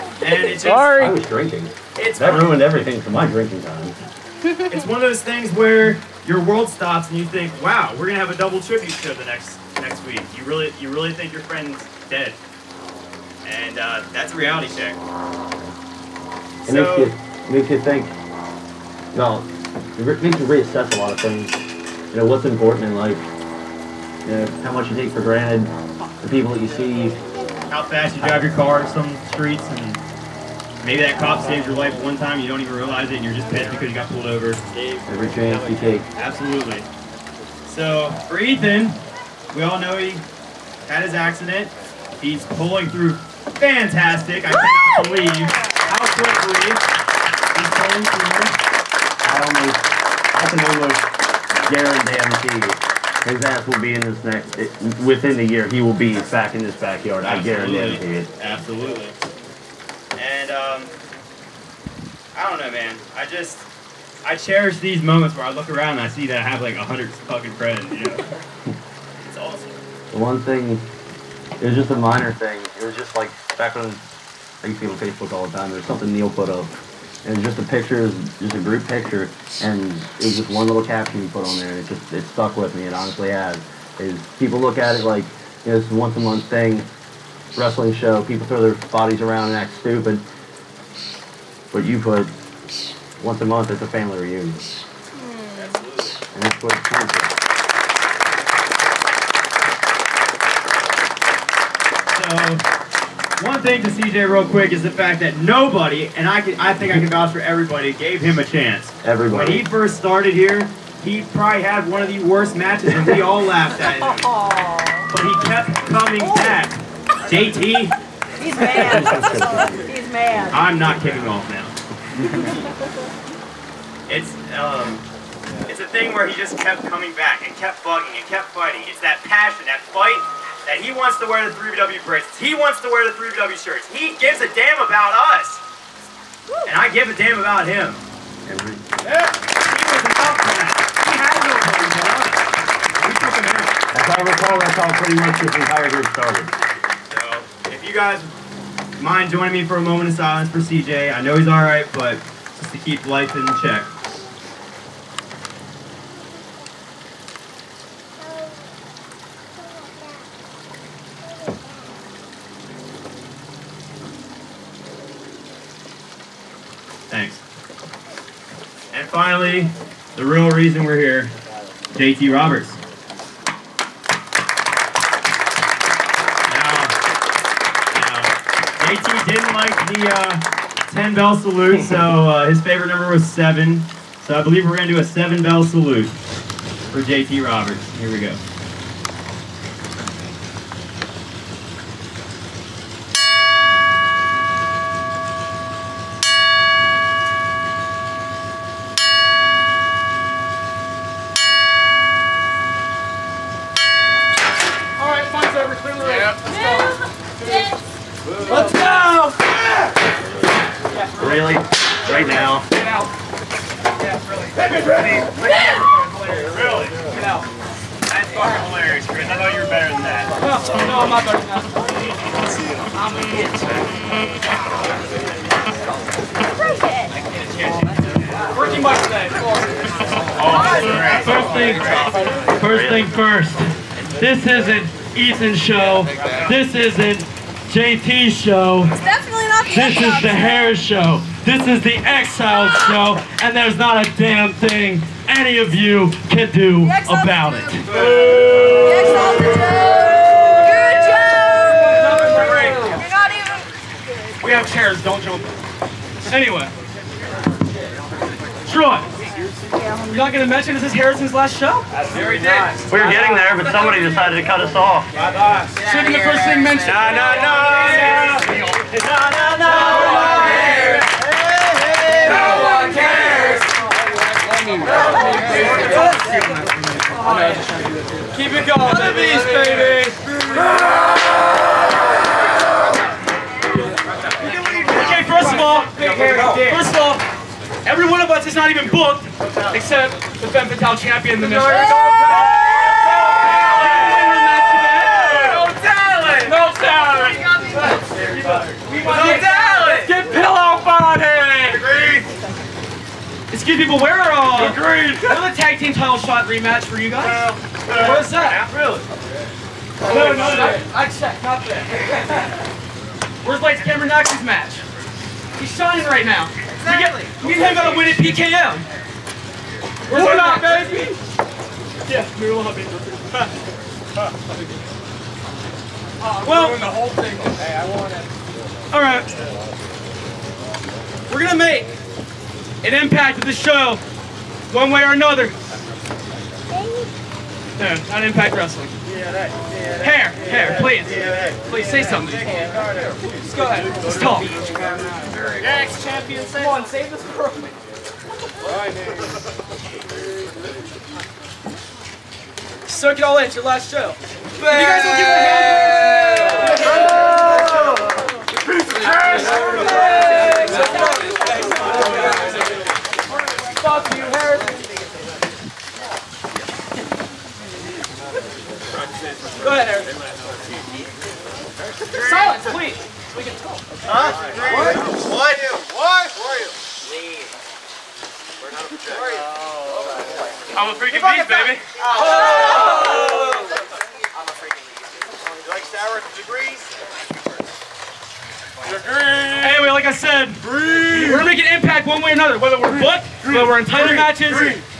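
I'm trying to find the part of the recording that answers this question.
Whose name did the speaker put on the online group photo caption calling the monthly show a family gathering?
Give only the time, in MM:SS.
01:16.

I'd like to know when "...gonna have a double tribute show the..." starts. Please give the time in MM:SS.
00:08.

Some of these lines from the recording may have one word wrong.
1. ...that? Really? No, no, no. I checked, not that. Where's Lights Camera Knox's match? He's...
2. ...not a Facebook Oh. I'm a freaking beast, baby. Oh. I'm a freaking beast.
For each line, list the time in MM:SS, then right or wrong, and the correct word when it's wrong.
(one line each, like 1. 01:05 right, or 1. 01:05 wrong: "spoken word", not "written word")
1. 05:08 right
2. 06:18 wrong: "Who", not "Facebook".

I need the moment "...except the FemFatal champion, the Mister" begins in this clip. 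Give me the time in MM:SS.
04:49.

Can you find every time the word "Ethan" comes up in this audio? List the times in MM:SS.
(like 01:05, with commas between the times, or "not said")
00:38, 03:55.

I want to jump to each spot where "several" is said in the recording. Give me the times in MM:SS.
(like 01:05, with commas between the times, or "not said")
not said.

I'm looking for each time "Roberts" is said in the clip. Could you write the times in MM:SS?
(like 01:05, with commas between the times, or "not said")
02:52, 03:07.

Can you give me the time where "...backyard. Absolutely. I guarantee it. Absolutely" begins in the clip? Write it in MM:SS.
00:56.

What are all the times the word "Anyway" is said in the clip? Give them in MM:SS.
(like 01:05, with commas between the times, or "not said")
04:16, 06:29.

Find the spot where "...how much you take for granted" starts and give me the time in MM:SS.
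00:24.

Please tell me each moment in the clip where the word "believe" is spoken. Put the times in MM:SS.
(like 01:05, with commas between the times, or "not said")
00:45, 03:04.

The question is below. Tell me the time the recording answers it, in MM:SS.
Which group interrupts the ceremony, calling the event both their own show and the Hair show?
04:01.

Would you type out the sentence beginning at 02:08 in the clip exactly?
It's that passion, that fight that he wants to wear the 3BW bracelets.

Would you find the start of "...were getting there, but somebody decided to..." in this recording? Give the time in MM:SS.
04:23.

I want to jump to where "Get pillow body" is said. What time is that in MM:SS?
05:00.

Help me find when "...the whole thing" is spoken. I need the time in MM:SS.
05:26.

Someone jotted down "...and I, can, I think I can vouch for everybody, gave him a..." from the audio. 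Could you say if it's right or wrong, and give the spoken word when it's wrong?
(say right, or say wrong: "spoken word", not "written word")
right.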